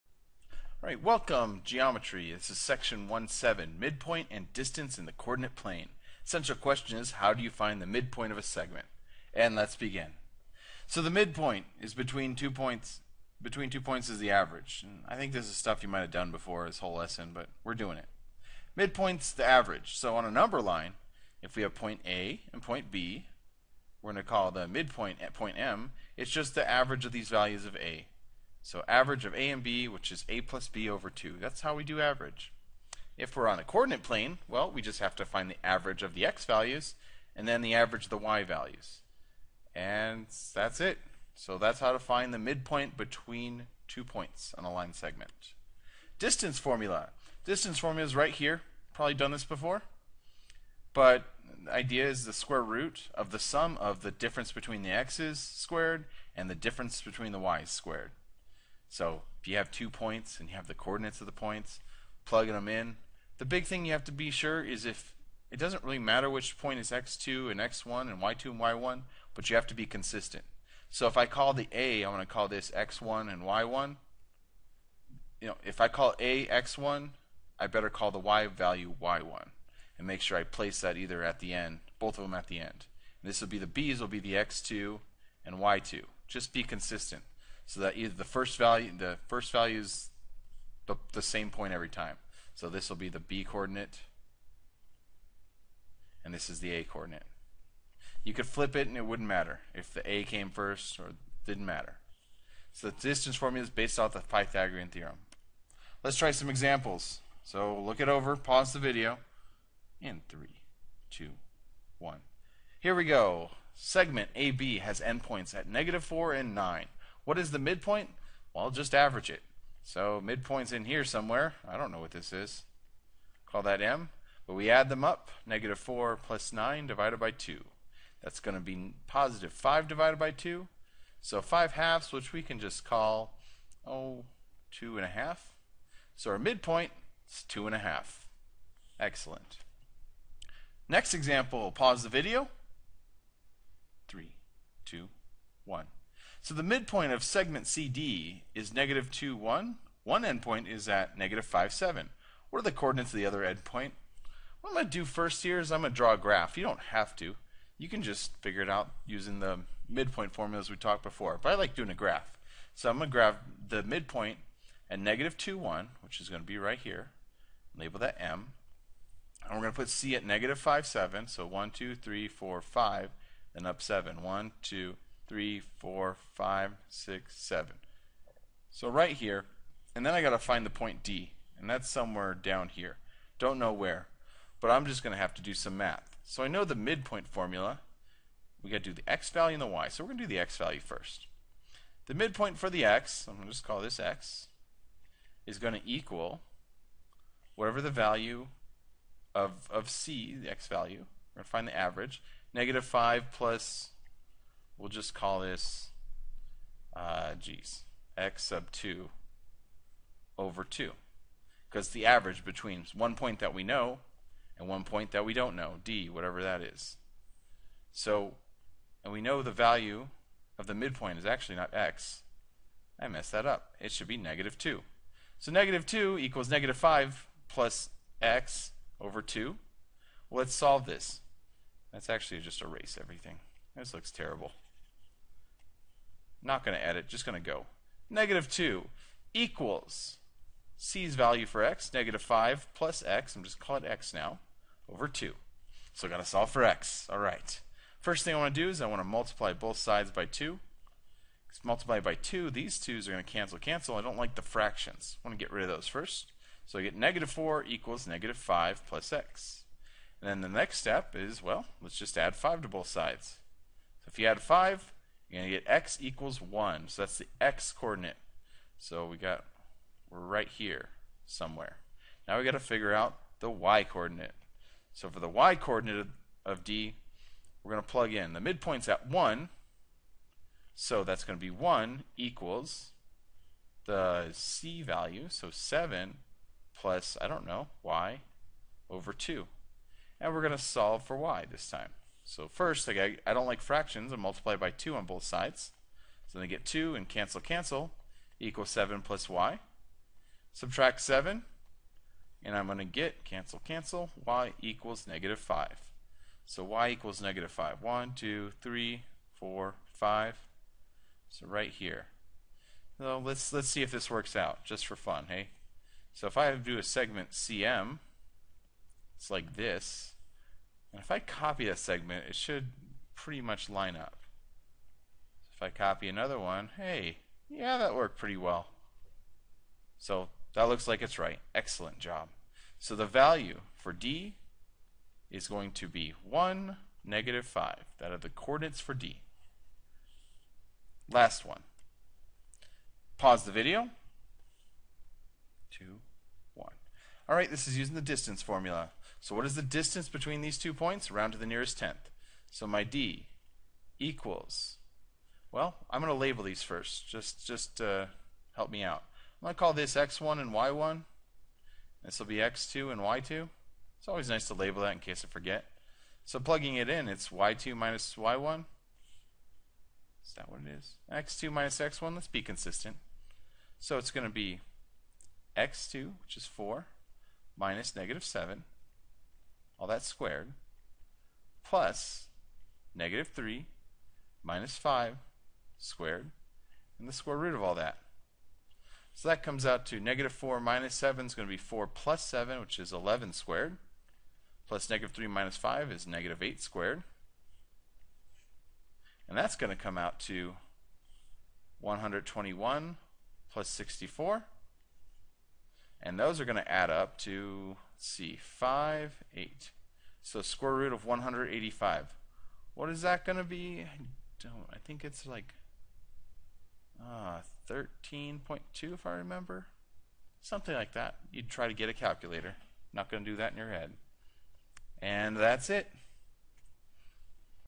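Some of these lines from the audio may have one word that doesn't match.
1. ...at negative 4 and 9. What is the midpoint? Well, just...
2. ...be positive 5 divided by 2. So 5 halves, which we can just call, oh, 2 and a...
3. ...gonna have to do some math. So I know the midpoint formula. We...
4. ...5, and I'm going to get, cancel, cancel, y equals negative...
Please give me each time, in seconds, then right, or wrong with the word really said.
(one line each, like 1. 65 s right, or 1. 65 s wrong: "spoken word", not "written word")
1. 115 s right
2. 128 s right
3. 185 s right
4. 301 s wrong: "7", not "5".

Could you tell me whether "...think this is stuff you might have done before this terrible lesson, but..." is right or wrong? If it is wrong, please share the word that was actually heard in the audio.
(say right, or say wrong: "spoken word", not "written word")
wrong: "whole", not "terrible".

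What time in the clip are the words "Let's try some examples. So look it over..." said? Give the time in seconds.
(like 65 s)
106 s.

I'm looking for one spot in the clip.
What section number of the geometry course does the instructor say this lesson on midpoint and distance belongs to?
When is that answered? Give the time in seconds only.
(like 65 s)
3 s.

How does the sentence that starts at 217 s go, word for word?
So, and we know the value of the midpoint is actually not x.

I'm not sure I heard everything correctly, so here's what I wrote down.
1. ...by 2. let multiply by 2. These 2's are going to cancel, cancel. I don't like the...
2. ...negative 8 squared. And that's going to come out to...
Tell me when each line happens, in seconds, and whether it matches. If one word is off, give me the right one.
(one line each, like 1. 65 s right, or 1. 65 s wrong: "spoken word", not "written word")
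1. 250 s right
2. 396 s right.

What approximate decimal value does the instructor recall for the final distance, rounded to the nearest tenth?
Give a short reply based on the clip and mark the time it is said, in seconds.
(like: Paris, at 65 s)
13.2, at 417 s.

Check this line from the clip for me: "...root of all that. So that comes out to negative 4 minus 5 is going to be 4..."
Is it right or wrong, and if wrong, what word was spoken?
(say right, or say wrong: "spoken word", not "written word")
wrong: "7", not "5".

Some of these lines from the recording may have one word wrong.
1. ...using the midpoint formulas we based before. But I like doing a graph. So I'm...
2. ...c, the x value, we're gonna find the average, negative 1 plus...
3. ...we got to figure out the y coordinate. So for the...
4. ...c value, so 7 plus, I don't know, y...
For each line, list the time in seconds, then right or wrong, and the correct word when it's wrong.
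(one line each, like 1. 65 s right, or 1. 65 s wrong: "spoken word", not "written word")
1. 159 s wrong: "talked", not "based"
2. 199 s wrong: "5", not "1"
3. 272 s right
4. 284 s right.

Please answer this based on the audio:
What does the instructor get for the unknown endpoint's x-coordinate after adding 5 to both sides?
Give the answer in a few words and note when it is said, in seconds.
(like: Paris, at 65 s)
x = 1, at 265 s.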